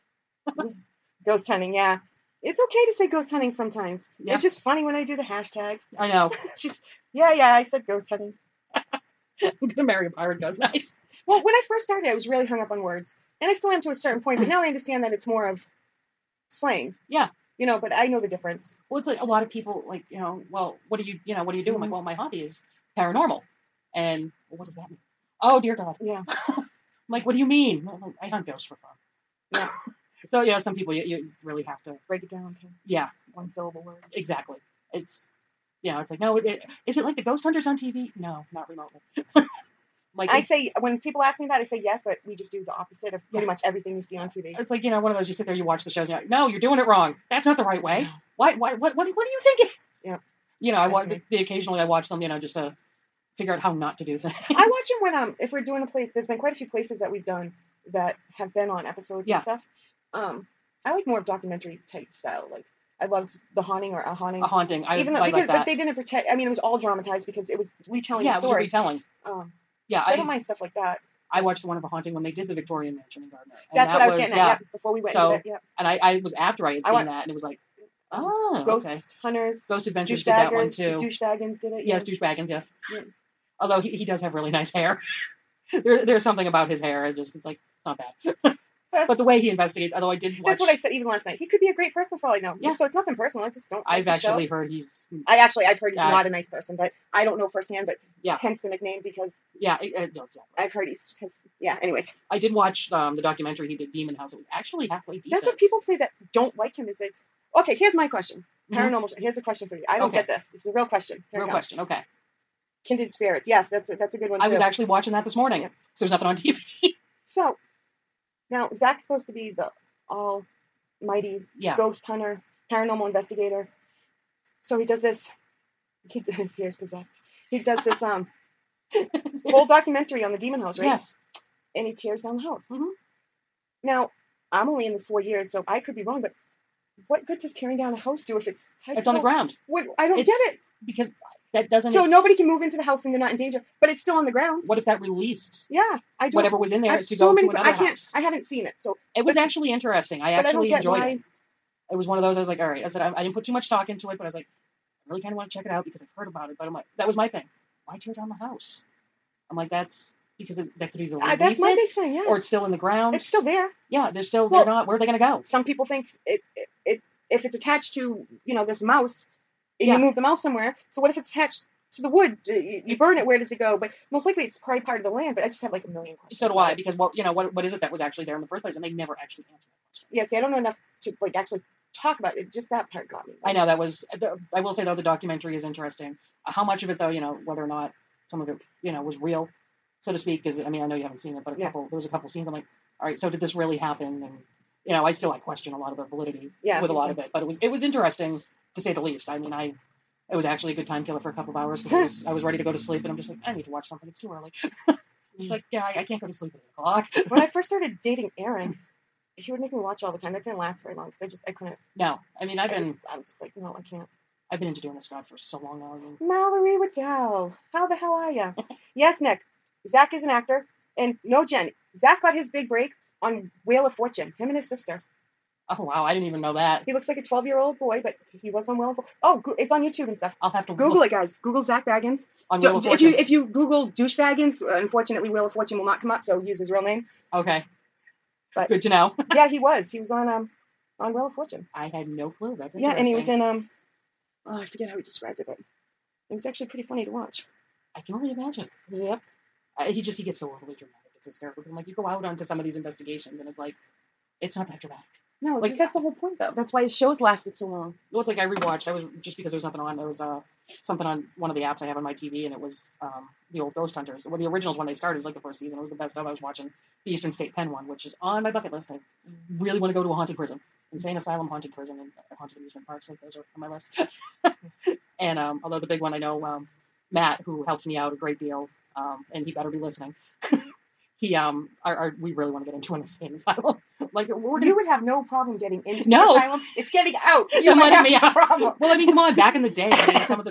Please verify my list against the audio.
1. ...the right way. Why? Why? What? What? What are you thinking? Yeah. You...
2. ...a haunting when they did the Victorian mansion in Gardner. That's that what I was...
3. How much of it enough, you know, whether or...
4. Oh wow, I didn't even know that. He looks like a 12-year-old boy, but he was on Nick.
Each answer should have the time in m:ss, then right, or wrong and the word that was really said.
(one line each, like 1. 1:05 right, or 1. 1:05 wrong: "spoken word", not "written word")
1. 0:47 right
2. 1:11 right
3. 3:06 wrong: "though", not "enough"
4. 3:45 wrong: "Fortune", not "Nick".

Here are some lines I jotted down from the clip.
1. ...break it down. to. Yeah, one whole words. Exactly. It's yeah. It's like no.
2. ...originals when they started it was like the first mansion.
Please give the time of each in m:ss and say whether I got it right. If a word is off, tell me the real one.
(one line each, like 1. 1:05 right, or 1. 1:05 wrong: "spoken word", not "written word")
1. 0:32 wrong: "syllable", not "whole"
2. 4:24 wrong: "season", not "mansion".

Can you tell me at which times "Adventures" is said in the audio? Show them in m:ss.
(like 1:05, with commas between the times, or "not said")
1:19.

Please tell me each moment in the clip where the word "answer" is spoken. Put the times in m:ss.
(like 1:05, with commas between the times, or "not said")
2:59.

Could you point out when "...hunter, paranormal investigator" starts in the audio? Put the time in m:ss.
2:02.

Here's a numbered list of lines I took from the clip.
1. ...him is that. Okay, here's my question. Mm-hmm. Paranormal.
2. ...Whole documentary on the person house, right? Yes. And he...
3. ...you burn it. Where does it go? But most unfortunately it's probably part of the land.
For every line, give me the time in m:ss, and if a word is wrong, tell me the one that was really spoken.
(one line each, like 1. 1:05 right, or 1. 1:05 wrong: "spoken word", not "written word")
1. 1:46 right
2. 2:09 wrong: "demon", not "person"
3. 2:52 wrong: "likely", not "unfortunately".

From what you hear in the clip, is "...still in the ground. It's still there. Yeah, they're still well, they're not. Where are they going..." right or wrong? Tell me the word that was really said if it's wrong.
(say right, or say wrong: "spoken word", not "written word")
right.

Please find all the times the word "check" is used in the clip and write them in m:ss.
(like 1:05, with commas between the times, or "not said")
2:35.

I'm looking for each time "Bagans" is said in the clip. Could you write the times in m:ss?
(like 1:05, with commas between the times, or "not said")
3:51.